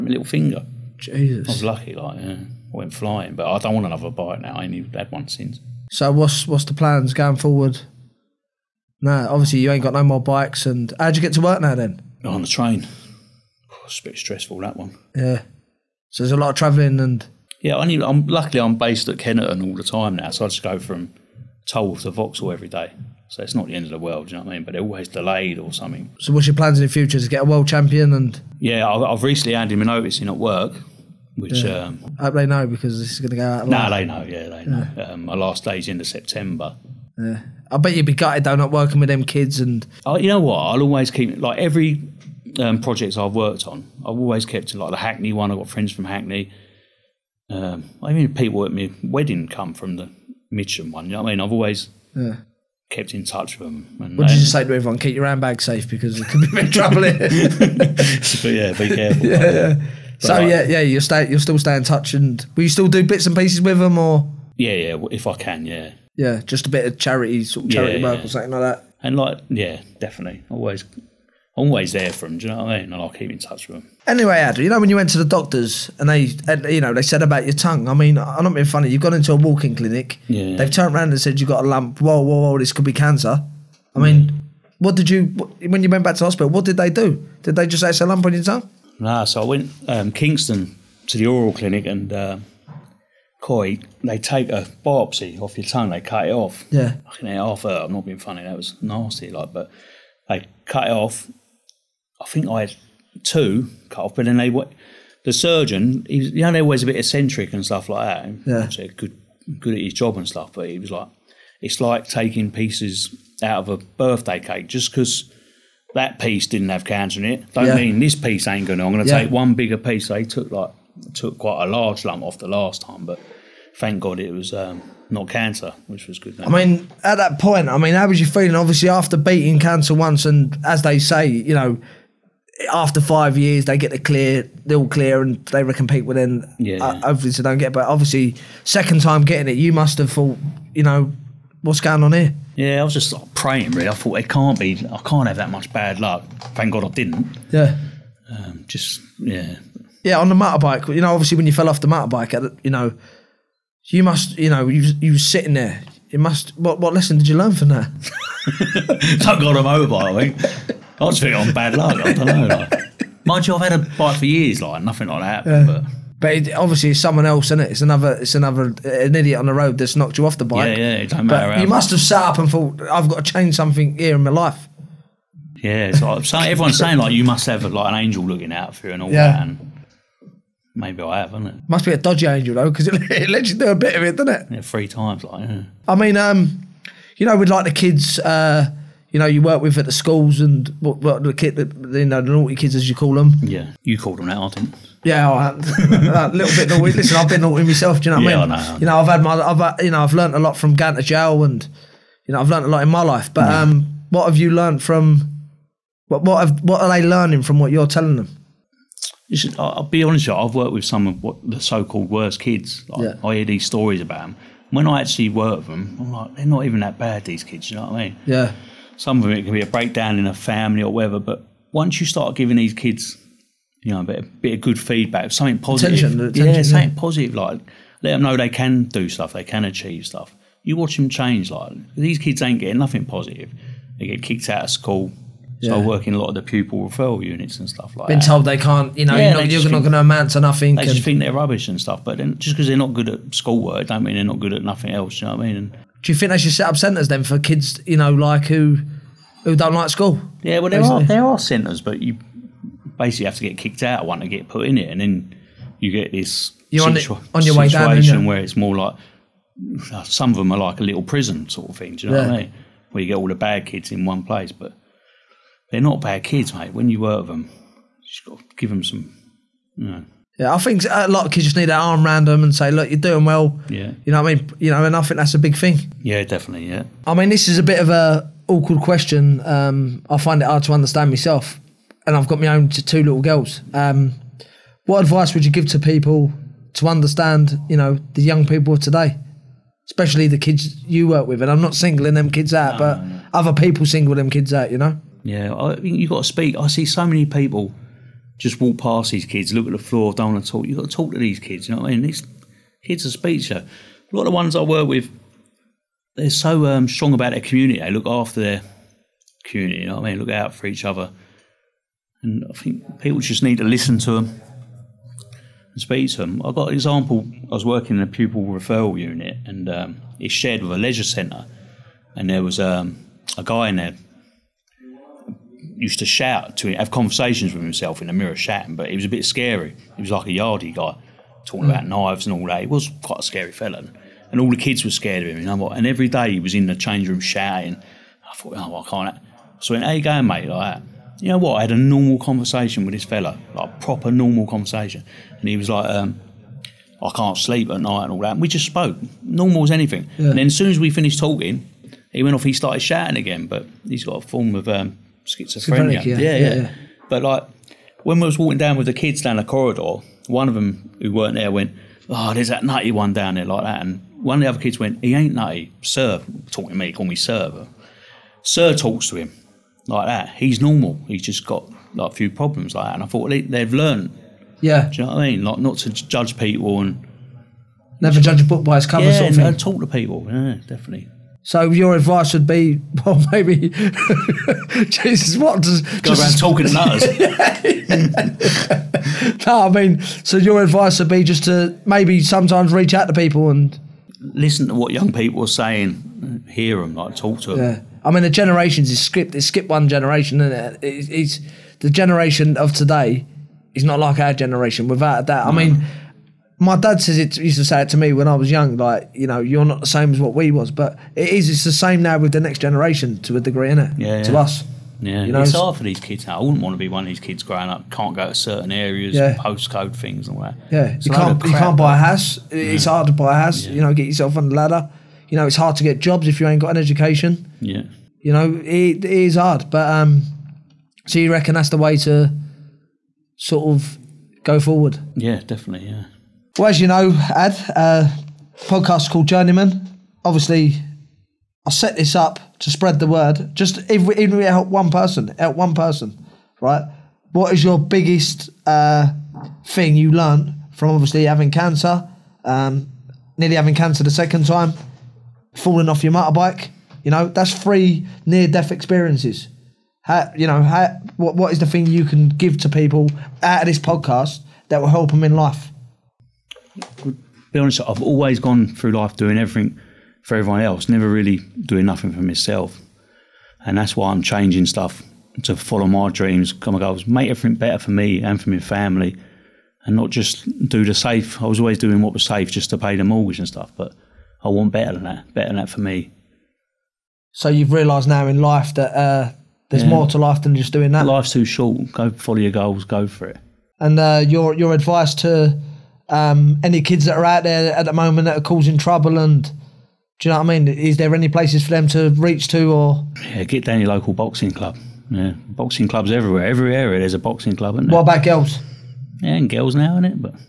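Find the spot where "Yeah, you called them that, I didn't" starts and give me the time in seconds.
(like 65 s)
193 s.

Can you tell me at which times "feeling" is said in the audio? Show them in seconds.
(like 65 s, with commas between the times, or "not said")
128 s, 161 s.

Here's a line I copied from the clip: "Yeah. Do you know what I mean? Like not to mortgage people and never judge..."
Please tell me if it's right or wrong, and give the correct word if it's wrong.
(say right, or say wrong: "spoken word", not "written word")
wrong: "judge", not "mortgage".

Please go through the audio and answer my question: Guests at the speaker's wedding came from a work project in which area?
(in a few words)
Mitcham.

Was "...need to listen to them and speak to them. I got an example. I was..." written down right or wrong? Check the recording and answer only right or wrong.
right.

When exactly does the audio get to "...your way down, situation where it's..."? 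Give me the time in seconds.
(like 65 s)
257 s.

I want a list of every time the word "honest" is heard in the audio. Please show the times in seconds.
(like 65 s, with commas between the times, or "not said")
210 s, 467 s.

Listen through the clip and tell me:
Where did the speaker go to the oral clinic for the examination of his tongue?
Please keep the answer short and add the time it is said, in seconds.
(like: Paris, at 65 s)
Kingston, at 90 s.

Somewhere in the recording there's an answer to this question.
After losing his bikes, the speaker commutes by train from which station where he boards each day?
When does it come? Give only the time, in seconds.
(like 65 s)
21 s.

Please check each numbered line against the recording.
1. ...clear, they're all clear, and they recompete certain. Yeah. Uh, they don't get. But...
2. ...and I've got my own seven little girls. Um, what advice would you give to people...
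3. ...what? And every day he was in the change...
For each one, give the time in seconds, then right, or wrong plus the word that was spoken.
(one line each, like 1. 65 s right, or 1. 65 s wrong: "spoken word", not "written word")
1. 133 s wrong: "within", not "certain"
2. 282 s wrong: "two", not "seven"
3. 335 s right.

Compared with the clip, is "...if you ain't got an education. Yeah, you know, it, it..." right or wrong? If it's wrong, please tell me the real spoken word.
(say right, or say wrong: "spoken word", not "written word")
right.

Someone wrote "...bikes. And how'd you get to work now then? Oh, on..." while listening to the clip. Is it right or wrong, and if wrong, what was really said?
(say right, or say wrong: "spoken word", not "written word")
right.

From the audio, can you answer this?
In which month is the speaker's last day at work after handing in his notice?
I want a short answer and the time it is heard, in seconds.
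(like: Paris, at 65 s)
September, at 36 s.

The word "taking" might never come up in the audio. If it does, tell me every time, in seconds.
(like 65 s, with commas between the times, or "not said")
112 s.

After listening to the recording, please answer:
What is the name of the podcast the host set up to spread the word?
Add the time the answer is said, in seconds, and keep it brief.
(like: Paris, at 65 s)
Journeyman, at 439 s.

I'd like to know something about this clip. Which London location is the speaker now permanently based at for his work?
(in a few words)
Kennington.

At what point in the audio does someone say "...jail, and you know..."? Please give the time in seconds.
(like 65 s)
201 s.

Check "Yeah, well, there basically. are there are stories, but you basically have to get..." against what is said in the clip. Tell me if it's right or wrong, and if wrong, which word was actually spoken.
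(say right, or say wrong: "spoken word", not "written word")
wrong: "centres", not "stories".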